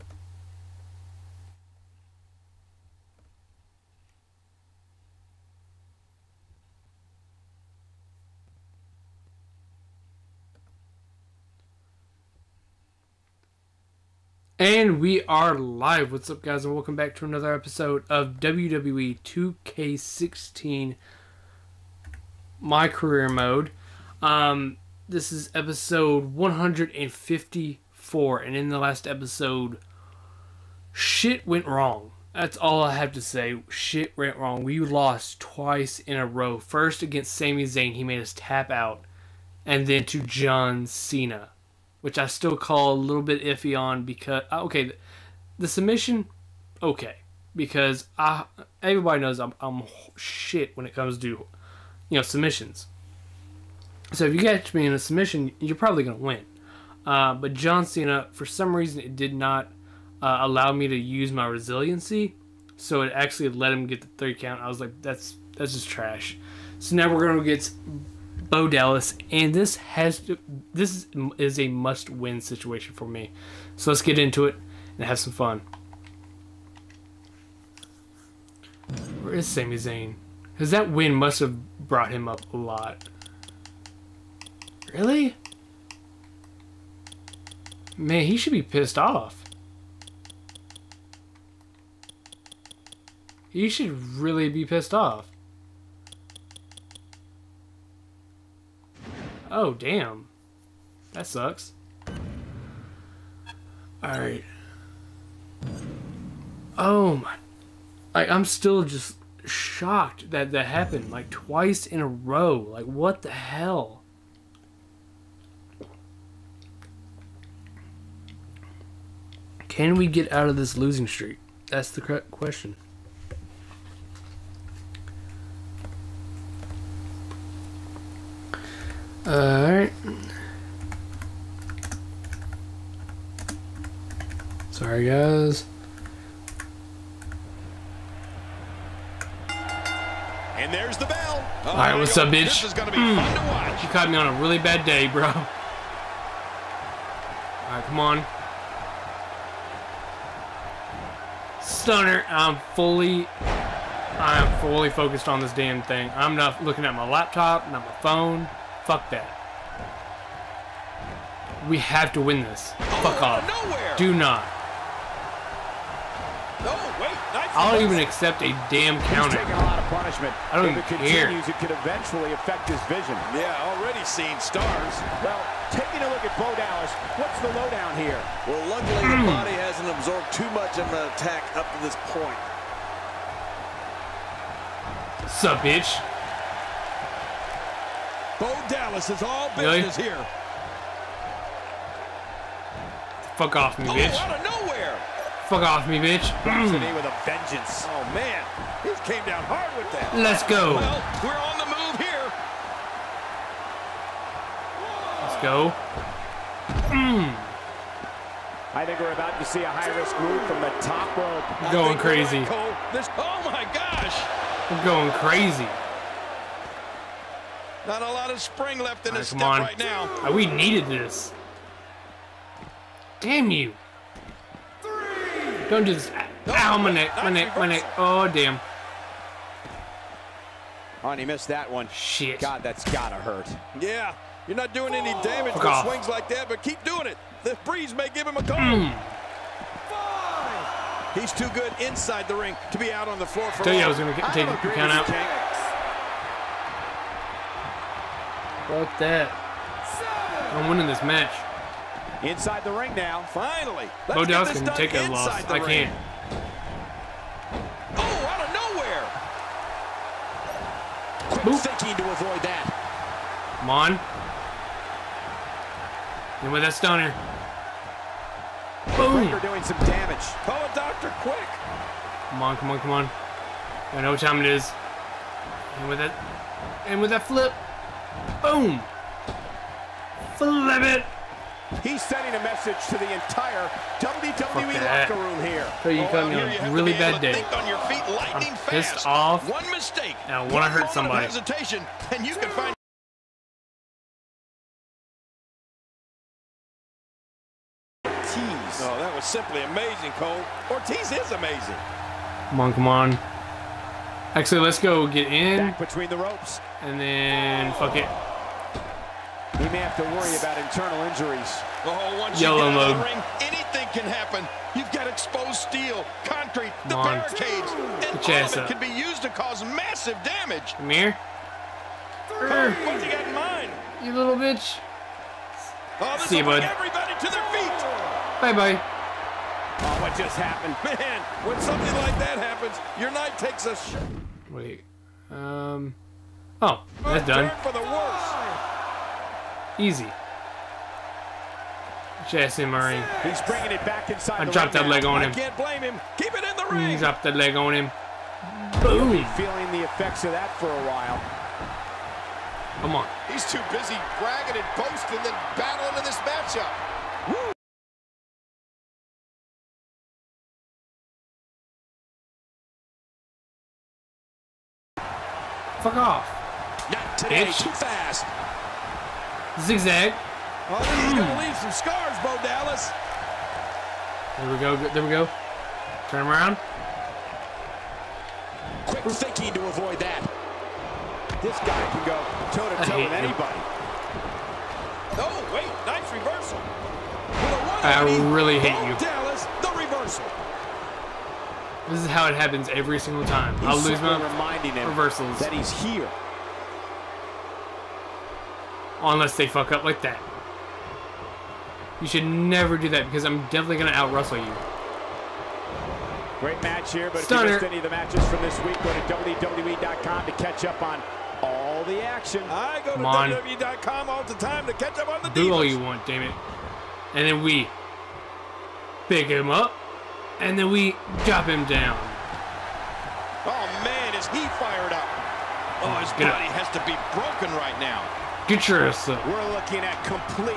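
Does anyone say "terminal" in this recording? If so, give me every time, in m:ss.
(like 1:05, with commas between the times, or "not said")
not said.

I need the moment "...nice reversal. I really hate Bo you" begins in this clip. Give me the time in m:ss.
6:25.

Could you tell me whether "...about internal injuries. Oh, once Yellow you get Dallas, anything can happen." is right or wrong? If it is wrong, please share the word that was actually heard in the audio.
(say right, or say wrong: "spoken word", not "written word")
wrong: "Ring", not "Dallas".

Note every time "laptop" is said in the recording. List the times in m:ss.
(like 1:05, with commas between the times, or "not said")
2:37.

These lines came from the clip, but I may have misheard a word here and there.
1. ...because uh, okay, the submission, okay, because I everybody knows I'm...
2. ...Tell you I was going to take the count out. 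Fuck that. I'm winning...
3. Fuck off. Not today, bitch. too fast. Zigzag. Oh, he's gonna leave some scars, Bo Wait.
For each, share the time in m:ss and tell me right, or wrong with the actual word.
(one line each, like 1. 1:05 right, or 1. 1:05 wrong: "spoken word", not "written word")
1. 0:44 right
2. 4:03 right
3. 6:05 wrong: "Dallas", not "Wait".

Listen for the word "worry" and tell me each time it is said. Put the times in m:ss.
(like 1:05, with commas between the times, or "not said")
5:10.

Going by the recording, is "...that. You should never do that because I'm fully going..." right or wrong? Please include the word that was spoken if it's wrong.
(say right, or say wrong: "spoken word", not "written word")
wrong: "definitely", not "fully".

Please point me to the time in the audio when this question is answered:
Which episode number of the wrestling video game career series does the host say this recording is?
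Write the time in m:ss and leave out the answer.
0:26.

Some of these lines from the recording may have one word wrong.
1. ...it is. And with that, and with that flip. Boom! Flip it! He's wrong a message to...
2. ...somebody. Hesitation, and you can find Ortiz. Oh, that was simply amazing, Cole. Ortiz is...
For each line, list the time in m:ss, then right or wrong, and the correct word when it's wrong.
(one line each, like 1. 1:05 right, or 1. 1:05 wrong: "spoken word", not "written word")
1. 4:34 wrong: "sending", not "wrong"
2. 4:50 right.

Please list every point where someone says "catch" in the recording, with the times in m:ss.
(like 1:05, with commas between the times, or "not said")
0:54, 6:50, 6:54.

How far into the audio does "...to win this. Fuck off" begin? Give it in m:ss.
2:42.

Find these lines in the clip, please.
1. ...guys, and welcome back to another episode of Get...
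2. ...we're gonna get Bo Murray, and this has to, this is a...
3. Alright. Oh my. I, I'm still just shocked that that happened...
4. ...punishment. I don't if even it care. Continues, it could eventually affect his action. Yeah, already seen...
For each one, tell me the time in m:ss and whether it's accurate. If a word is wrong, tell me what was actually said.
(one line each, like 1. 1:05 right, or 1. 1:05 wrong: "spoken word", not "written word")
1. 0:16 wrong: "WWE", not "Get"
2. 1:07 wrong: "Dallas", not "Murray"
3. 1:44 right
4. 2:49 wrong: "vision", not "action".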